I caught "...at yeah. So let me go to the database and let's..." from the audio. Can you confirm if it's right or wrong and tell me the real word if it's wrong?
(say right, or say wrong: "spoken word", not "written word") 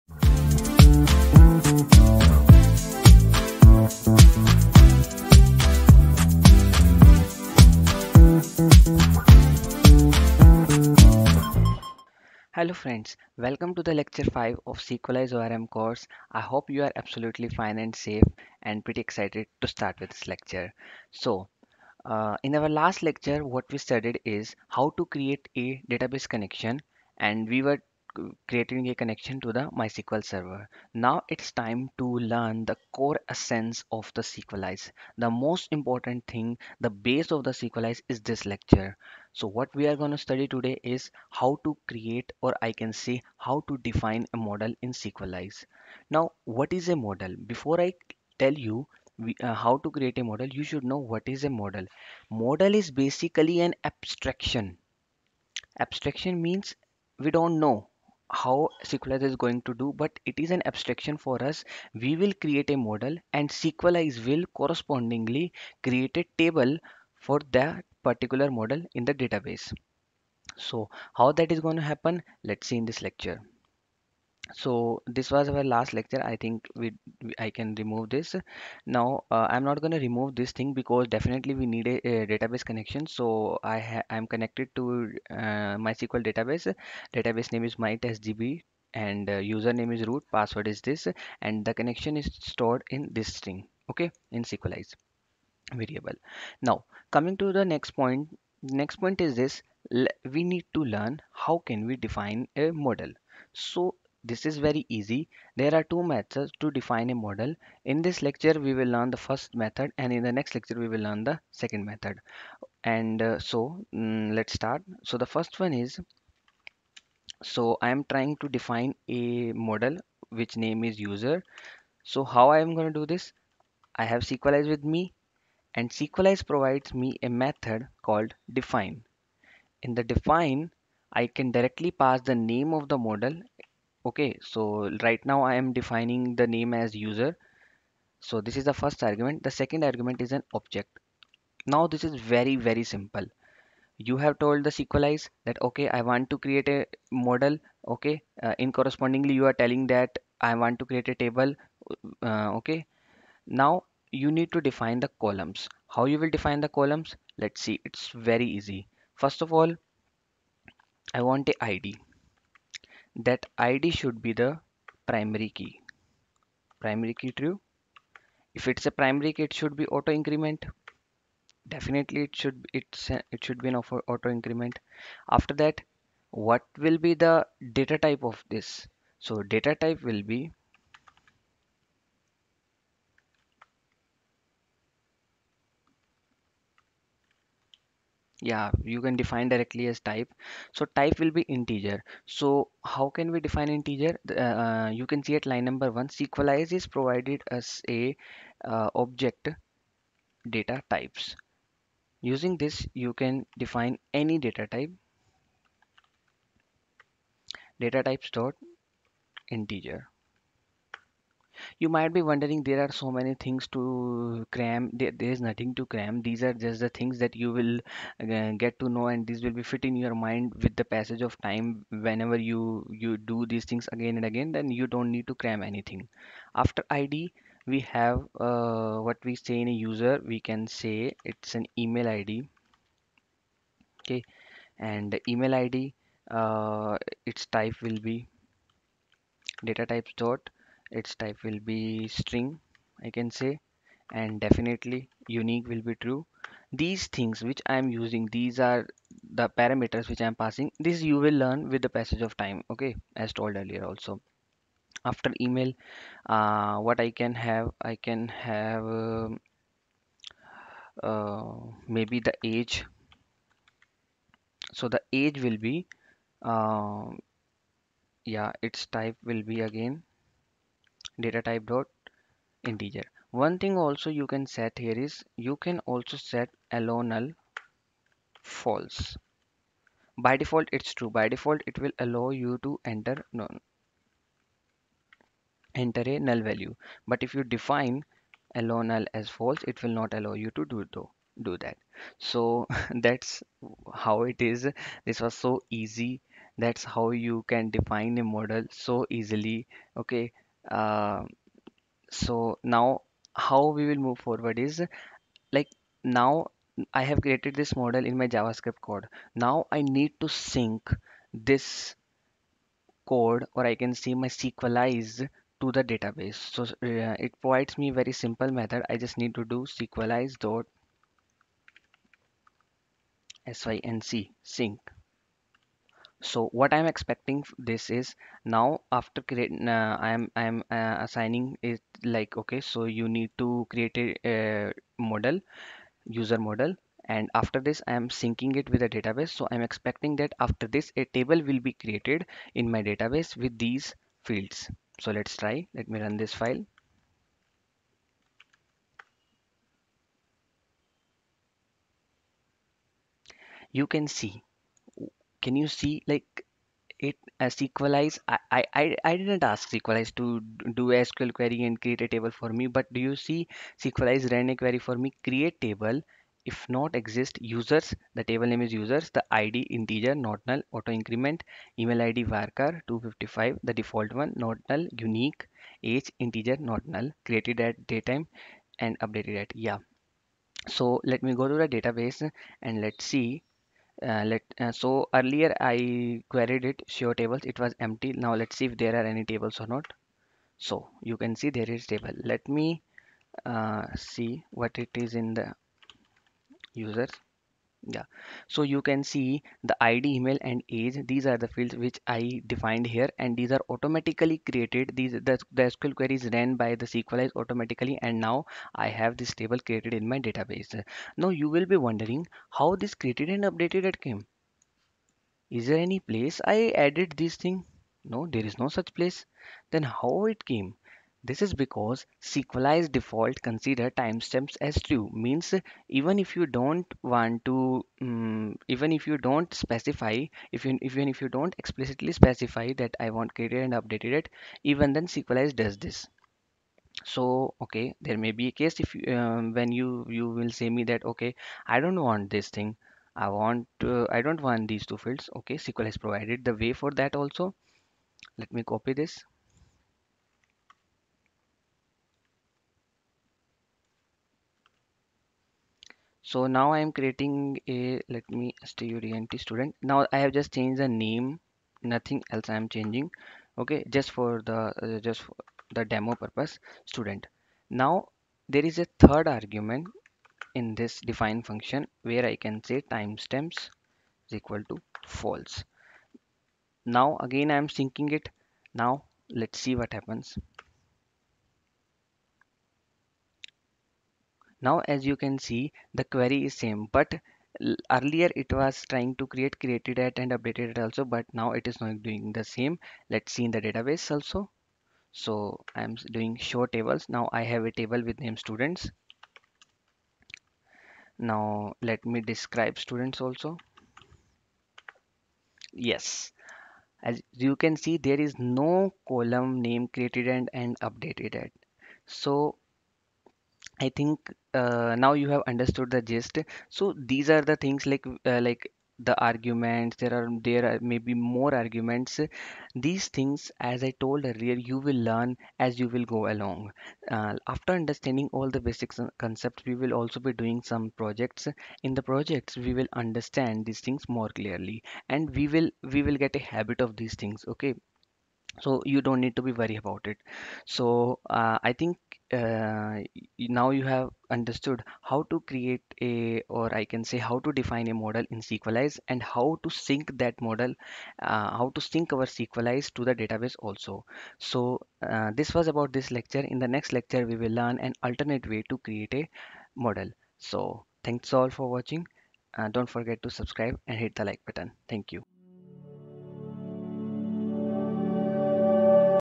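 right.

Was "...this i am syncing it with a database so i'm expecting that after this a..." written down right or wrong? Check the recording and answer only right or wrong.
right.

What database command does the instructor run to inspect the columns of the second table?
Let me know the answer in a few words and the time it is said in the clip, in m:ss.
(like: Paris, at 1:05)
describe students, at 8:22.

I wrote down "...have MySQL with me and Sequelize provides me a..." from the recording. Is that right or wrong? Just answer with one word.
wrong.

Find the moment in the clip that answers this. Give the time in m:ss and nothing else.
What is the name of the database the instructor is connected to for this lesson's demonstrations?
1:27.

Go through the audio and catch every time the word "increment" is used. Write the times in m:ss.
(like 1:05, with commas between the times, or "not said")
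2:50, 2:54, 6:10.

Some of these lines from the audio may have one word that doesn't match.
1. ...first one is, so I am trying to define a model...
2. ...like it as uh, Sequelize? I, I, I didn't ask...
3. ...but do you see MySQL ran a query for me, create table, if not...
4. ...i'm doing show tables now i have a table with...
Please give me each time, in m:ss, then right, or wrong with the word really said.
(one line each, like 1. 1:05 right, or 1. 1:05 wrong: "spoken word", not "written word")
1. 1:55 right
2. 5:56 right
3. 6:02 wrong: "Sequelize", not "MySQL"
4. 8:15 right.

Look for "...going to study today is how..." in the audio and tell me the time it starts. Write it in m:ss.
0:39.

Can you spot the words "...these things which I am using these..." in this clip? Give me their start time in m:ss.
4:06.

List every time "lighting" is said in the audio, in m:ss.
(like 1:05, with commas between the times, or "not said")
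not said.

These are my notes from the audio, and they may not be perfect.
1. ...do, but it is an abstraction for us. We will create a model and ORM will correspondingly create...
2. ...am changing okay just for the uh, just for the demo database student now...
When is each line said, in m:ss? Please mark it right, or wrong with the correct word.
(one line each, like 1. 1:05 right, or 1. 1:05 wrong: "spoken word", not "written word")
1. 0:59 wrong: "Sequelize", not "ORM"
2. 7:42 wrong: "purpose", not "database".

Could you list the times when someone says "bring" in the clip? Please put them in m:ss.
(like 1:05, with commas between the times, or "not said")
not said.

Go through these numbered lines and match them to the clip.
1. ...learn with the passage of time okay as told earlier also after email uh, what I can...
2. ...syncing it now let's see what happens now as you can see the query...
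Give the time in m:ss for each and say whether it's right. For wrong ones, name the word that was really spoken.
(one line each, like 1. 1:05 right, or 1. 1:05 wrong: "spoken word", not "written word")
1. 4:11 right
2. 7:57 right.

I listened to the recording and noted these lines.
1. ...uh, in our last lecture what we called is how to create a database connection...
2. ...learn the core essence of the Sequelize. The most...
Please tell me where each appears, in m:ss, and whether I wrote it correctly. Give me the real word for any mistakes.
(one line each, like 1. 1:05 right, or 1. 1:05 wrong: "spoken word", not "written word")
1. 0:22 wrong: "studied", not "called"
2. 0:32 right.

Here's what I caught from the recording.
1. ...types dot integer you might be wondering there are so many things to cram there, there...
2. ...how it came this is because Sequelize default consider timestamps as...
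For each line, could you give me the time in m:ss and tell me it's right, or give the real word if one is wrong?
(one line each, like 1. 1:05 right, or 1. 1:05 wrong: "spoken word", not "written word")
1. 3:28 right
2. 6:59 right.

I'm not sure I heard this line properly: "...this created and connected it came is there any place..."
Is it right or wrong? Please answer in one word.
wrong.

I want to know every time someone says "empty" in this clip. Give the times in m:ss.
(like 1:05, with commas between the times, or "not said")
6:27.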